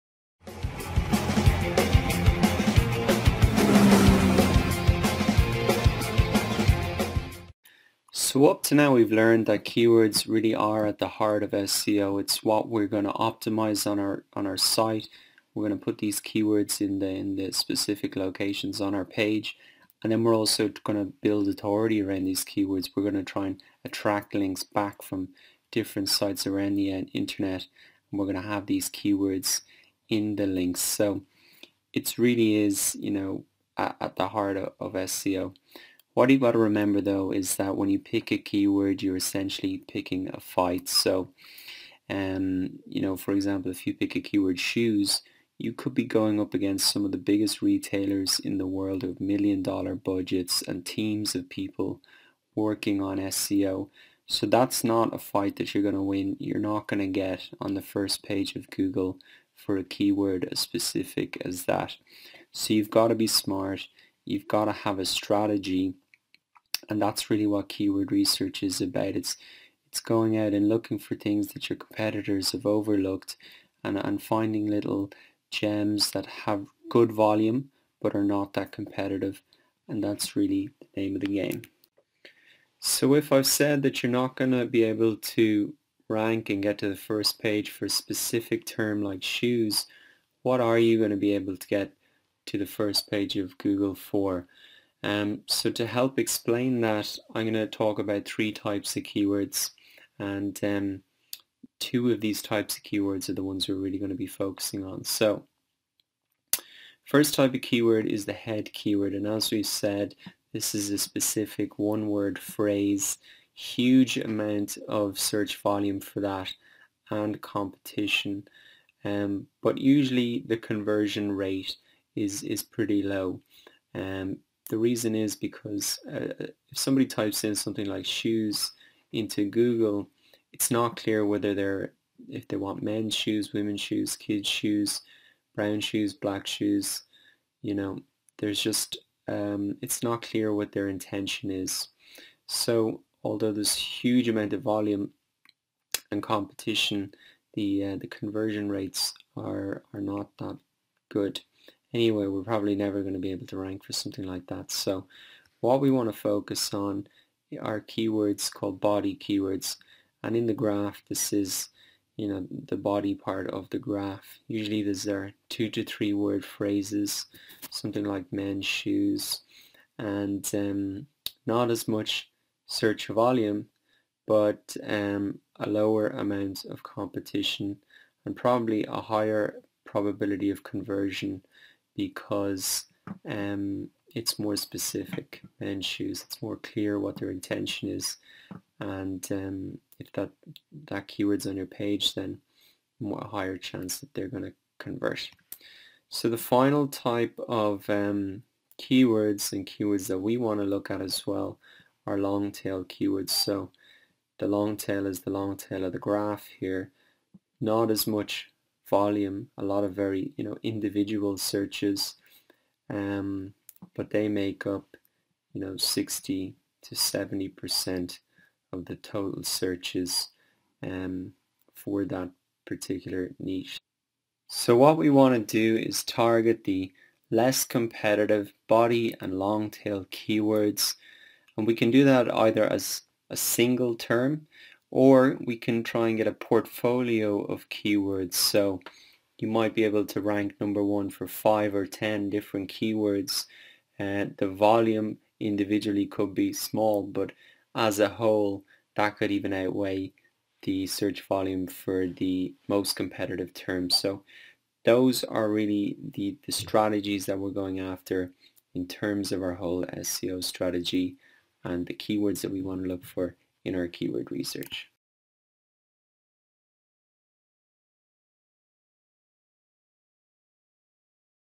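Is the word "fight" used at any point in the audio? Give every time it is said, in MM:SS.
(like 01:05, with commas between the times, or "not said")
00:40, 00:55.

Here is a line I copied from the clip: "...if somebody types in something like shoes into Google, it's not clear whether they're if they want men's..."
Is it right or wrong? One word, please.
right.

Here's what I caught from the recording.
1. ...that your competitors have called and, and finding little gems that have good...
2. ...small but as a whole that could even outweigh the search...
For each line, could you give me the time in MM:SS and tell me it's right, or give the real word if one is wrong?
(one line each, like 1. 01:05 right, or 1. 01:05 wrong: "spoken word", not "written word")
1. 01:11 wrong: "overlooked", not "called"
2. 04:06 right.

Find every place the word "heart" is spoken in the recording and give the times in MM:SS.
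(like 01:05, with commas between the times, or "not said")
00:11, 00:34.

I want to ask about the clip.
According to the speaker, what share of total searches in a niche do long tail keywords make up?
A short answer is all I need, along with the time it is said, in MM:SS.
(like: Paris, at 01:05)
60 to 70%, at 03:35.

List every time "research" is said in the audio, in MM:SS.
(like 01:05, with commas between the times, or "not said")
01:08, 04:24.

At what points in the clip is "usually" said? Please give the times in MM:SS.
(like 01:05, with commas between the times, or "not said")
01:59, 02:44.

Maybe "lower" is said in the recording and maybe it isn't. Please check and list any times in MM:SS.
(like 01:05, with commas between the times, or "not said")
02:55.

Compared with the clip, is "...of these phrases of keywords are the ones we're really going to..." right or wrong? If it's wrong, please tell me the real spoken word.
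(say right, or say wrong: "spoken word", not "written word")
wrong: "types", not "phrases".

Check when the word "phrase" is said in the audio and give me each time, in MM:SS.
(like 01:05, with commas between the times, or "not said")
01:52, 02:46.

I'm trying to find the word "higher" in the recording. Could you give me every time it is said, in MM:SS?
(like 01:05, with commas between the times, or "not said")
02:59, 03:13.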